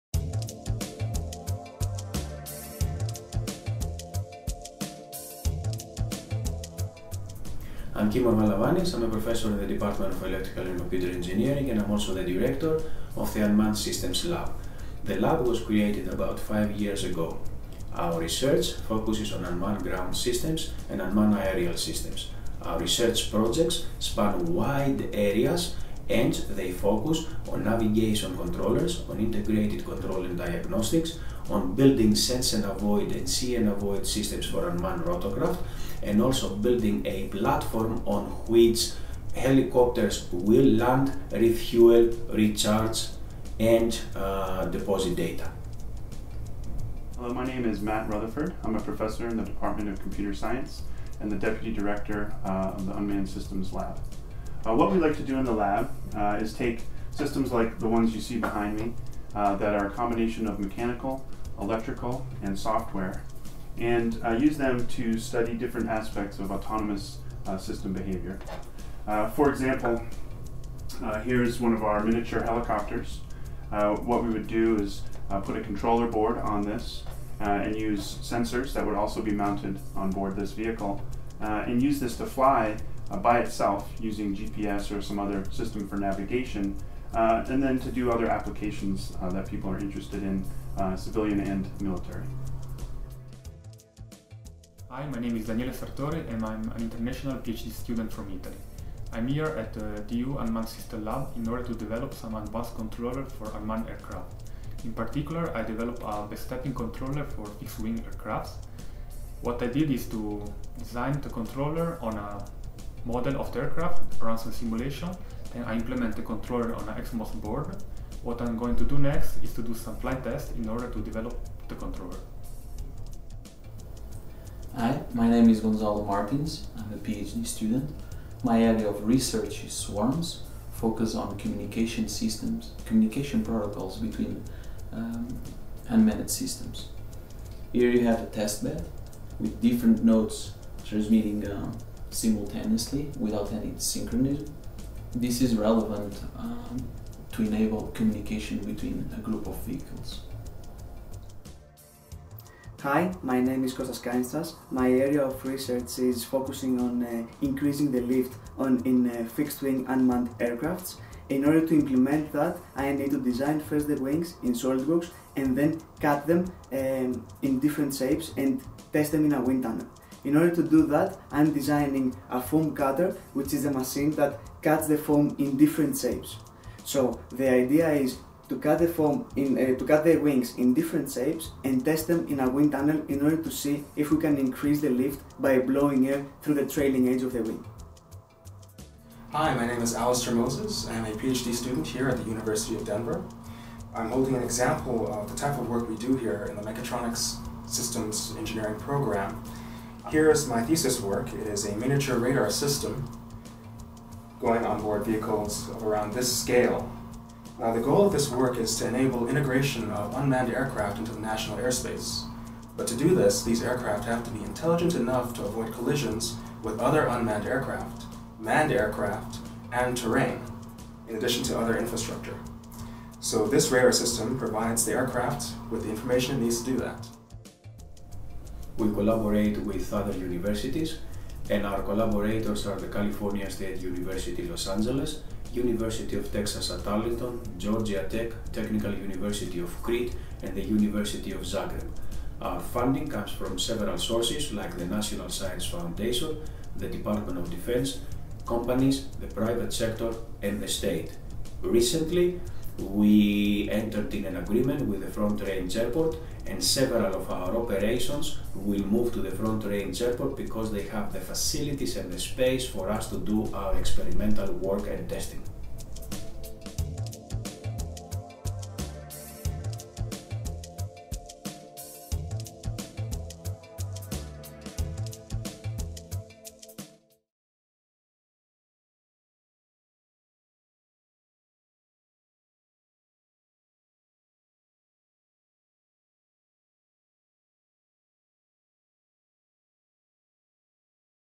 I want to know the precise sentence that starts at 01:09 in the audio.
Uh, for example, uh, here's one of our miniature helicopters.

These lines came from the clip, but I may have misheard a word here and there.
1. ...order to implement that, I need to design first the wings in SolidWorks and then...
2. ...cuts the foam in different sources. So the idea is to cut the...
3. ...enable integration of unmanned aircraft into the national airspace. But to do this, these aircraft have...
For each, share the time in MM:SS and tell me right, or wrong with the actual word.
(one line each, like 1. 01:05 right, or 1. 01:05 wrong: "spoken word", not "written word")
1. 02:41 right
2. 02:54 wrong: "shapes", not "sources"
3. 03:28 right.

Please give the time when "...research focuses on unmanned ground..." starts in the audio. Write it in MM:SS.
00:18.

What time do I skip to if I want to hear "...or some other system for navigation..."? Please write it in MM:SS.
01:24.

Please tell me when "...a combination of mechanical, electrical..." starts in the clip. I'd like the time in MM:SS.
00:59.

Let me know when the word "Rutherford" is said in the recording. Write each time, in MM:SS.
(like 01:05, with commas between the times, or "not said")
00:48.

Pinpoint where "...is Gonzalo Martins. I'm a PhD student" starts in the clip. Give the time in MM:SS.
02:05.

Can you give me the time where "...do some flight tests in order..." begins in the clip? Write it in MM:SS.
01:59.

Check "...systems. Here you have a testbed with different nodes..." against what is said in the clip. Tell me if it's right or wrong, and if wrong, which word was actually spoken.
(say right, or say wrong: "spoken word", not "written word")
right.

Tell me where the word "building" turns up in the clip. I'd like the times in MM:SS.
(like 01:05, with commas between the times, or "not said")
00:31, 00:36.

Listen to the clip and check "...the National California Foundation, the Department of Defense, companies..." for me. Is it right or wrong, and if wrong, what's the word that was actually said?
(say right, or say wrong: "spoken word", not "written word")
wrong: "Science", not "California".